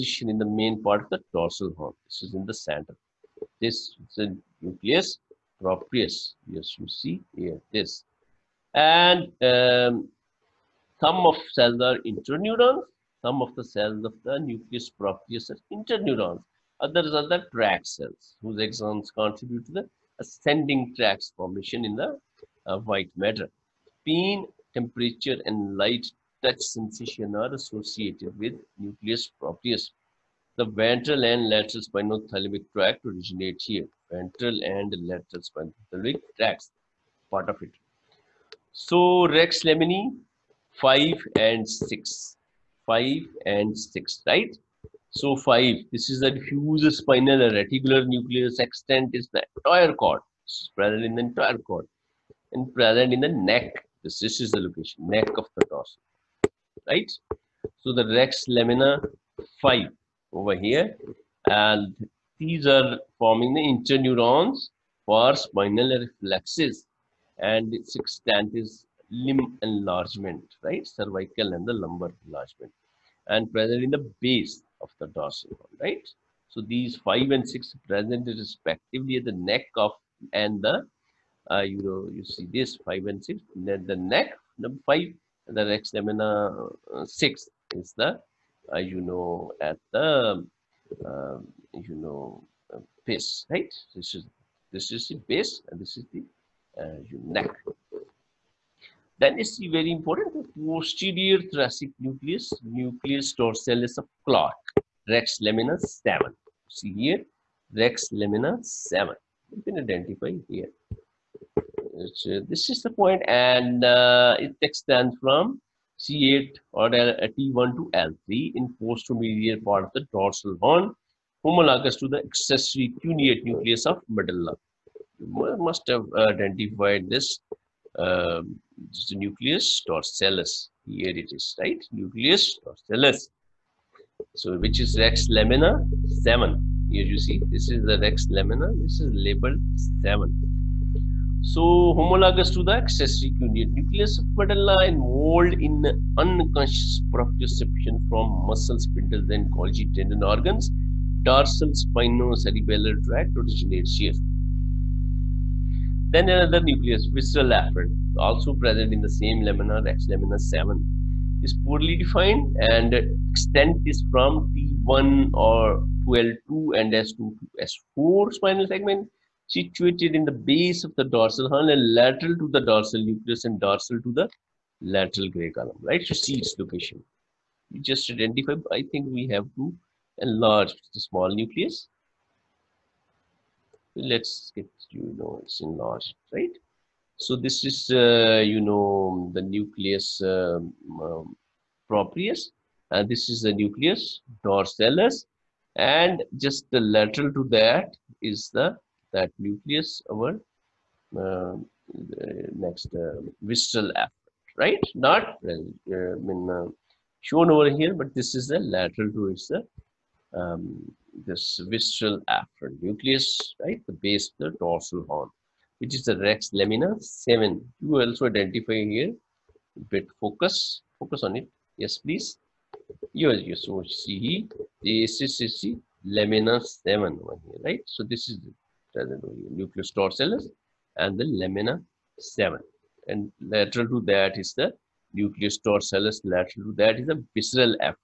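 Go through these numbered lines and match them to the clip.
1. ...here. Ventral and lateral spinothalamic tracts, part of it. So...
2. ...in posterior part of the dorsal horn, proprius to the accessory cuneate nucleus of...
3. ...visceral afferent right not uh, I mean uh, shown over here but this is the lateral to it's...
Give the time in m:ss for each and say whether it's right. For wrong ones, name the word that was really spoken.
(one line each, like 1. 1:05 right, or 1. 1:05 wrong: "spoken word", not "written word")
1. 0:33 right
2. 1:58 wrong: "homologous", not "proprius"
3. 3:23 right.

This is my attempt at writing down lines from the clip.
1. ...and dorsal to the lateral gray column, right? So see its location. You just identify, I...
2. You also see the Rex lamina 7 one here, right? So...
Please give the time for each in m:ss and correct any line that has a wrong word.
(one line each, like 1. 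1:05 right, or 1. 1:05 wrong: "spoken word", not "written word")
1. 2:53 right
2. 3:43 wrong: "ACCC", not "Rex".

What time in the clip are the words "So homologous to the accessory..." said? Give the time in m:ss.
2:21.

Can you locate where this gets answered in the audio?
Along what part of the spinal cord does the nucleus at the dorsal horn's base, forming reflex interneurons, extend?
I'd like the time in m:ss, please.
1:09.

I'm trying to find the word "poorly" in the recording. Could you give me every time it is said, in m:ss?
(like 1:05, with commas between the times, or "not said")
2:41.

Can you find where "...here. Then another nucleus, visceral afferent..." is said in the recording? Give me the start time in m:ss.
2:33.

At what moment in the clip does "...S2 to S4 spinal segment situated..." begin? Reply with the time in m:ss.
2:46.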